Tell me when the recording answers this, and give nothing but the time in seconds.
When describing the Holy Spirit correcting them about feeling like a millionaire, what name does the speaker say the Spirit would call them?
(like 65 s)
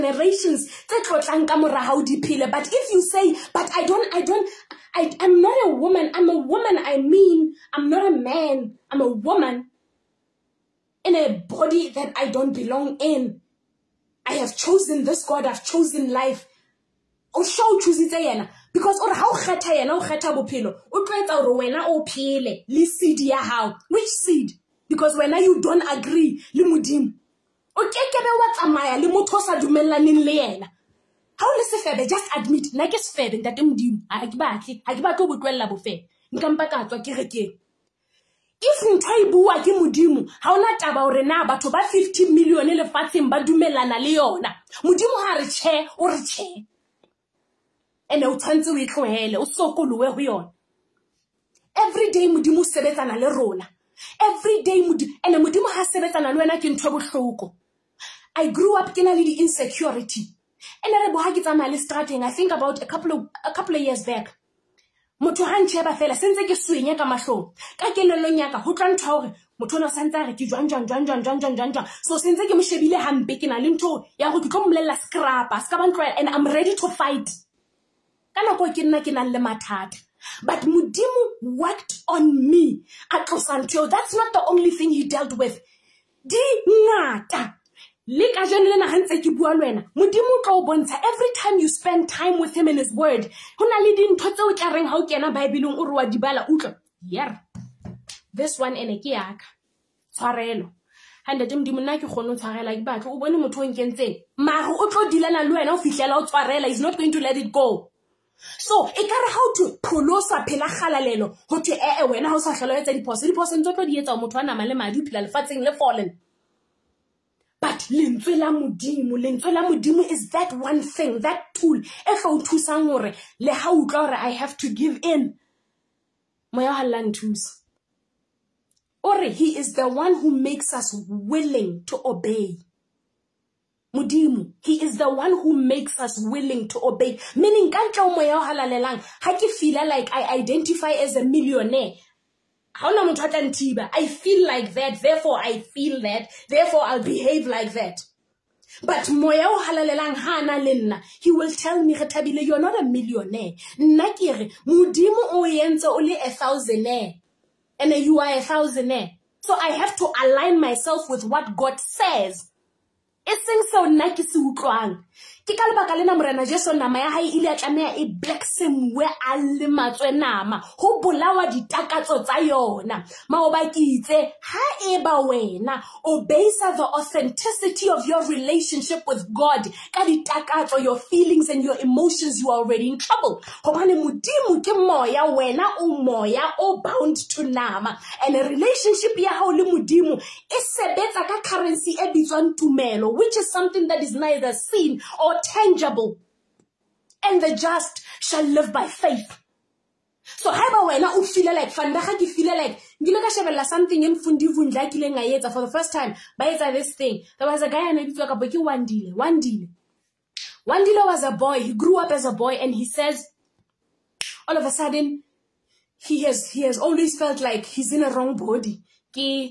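151 s.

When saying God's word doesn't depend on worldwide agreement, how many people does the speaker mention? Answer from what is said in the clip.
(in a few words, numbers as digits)
50 million.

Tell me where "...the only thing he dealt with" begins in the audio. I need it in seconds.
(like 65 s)
84 s.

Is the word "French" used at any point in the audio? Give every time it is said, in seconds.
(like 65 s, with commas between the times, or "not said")
not said.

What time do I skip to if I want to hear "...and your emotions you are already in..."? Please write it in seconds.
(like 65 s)
181 s.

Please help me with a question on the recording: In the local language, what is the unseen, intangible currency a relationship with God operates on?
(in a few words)
tumelo.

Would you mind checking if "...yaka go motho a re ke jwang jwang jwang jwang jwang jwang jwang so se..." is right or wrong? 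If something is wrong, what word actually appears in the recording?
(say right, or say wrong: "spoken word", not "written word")
right.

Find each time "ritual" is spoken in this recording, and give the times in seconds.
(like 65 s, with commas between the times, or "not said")
not said.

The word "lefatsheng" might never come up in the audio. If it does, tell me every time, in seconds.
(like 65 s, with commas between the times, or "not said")
42 s, 115 s.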